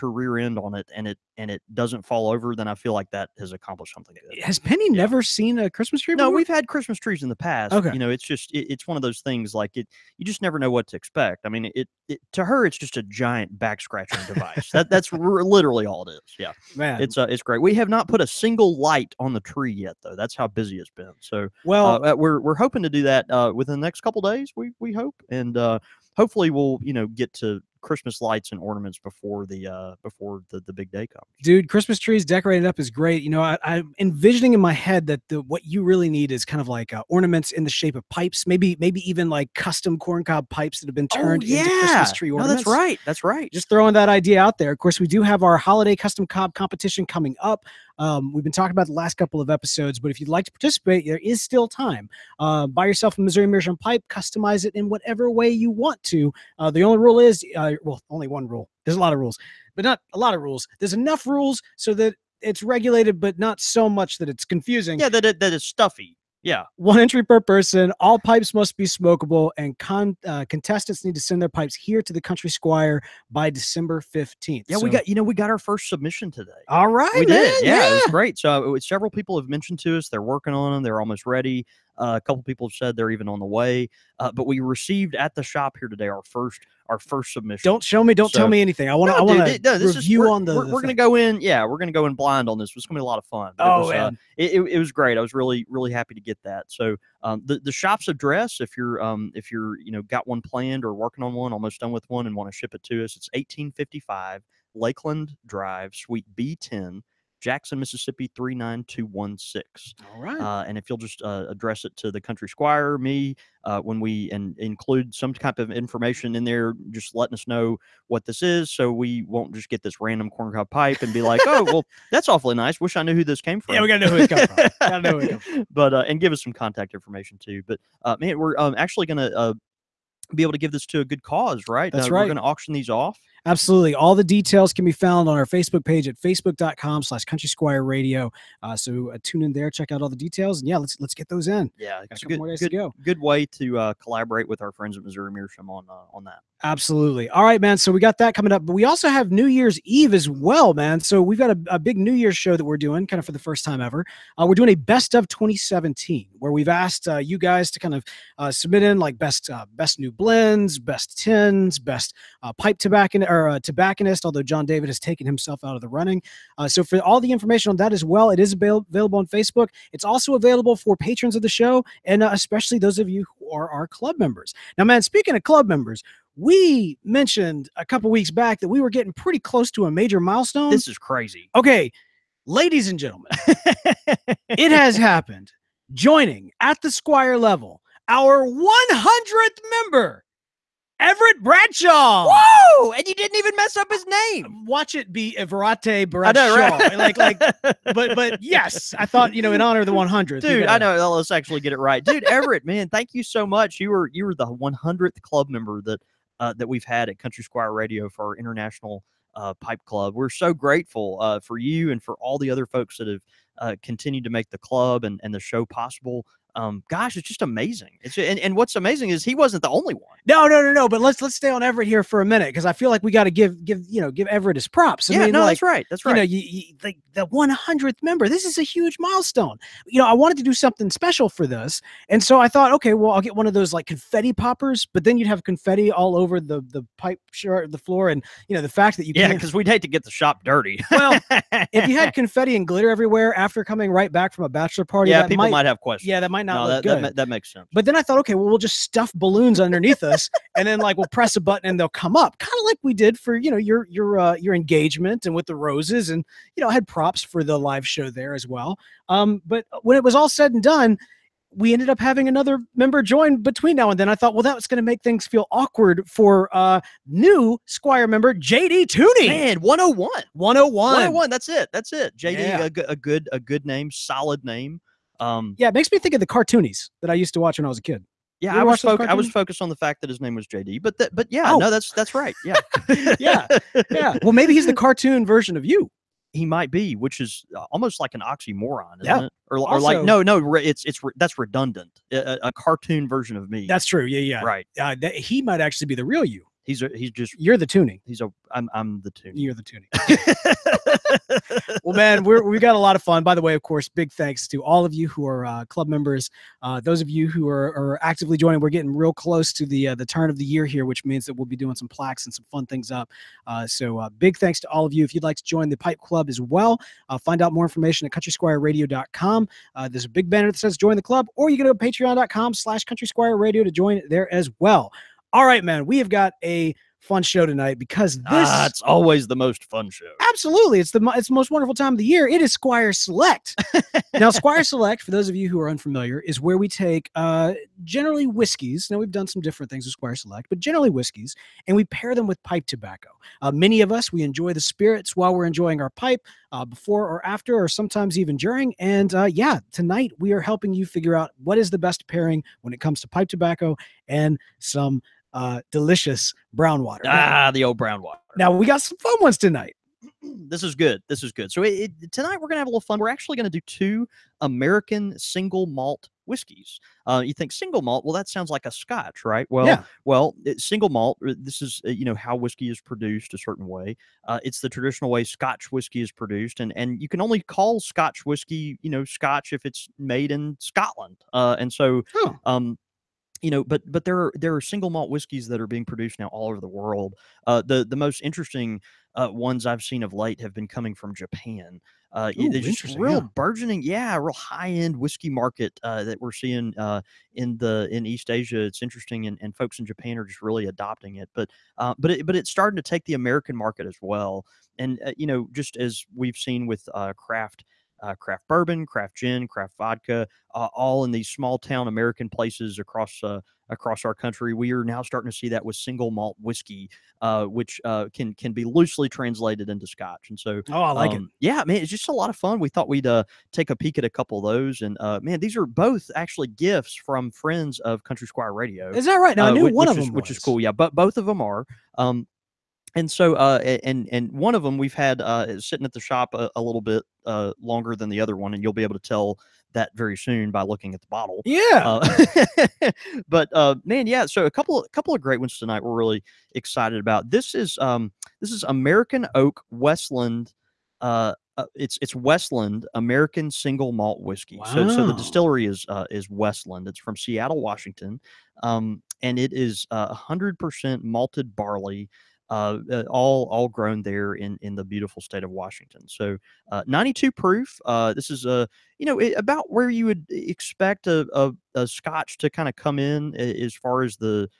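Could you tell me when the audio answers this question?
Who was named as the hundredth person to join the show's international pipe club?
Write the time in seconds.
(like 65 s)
190 s.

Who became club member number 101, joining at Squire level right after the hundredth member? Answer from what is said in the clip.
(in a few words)
JD Tooney.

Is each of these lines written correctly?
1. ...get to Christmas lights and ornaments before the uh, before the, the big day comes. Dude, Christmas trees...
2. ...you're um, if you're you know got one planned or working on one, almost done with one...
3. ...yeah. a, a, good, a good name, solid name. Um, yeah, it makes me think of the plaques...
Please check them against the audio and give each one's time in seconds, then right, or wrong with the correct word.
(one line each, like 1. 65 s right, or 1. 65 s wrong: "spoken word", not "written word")
1. 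27 s right
2. 98 s right
3. 272 s wrong: "cartoonies", not "plaques".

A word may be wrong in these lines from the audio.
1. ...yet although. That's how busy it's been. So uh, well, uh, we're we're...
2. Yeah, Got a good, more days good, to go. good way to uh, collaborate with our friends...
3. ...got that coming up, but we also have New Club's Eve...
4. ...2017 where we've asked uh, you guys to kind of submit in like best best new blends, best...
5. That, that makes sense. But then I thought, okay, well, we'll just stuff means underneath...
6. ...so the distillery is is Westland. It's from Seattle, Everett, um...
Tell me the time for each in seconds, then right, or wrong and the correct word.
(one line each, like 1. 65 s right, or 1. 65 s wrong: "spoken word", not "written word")
1. 19 s wrong: "though", not "although"
2. 141 s right
3. 148 s wrong: "Year", not "Club"
4. 155 s right
5. 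247 s wrong: "balloons", not "means"
6. 454 s wrong: "Washington", not "Everett".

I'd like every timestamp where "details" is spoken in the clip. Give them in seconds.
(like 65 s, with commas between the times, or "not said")
134 s, 140 s.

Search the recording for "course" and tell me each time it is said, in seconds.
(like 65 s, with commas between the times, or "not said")
44 s, 303 s.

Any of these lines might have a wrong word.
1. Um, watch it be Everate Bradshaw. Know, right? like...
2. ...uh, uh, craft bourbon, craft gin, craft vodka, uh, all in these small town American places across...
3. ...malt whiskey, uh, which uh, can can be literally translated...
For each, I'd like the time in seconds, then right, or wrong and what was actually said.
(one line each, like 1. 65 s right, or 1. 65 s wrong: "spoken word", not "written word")
1. 194 s right
2. 407 s right
3. 416 s wrong: "loosely", not "literally".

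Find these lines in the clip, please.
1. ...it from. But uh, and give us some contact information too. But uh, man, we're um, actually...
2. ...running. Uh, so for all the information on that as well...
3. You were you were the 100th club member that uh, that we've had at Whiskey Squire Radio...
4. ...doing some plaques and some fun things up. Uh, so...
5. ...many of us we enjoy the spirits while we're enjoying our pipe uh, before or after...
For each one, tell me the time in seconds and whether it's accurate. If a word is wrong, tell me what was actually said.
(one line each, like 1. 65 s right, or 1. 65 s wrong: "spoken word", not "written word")
1. 125 s right
2. 165 s right
3. 203 s wrong: "Country", not "Whiskey"
4. 311 s right
5. 343 s right.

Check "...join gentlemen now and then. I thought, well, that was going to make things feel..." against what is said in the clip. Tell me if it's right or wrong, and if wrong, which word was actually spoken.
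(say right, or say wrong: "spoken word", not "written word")
wrong: "between", not "gentlemen".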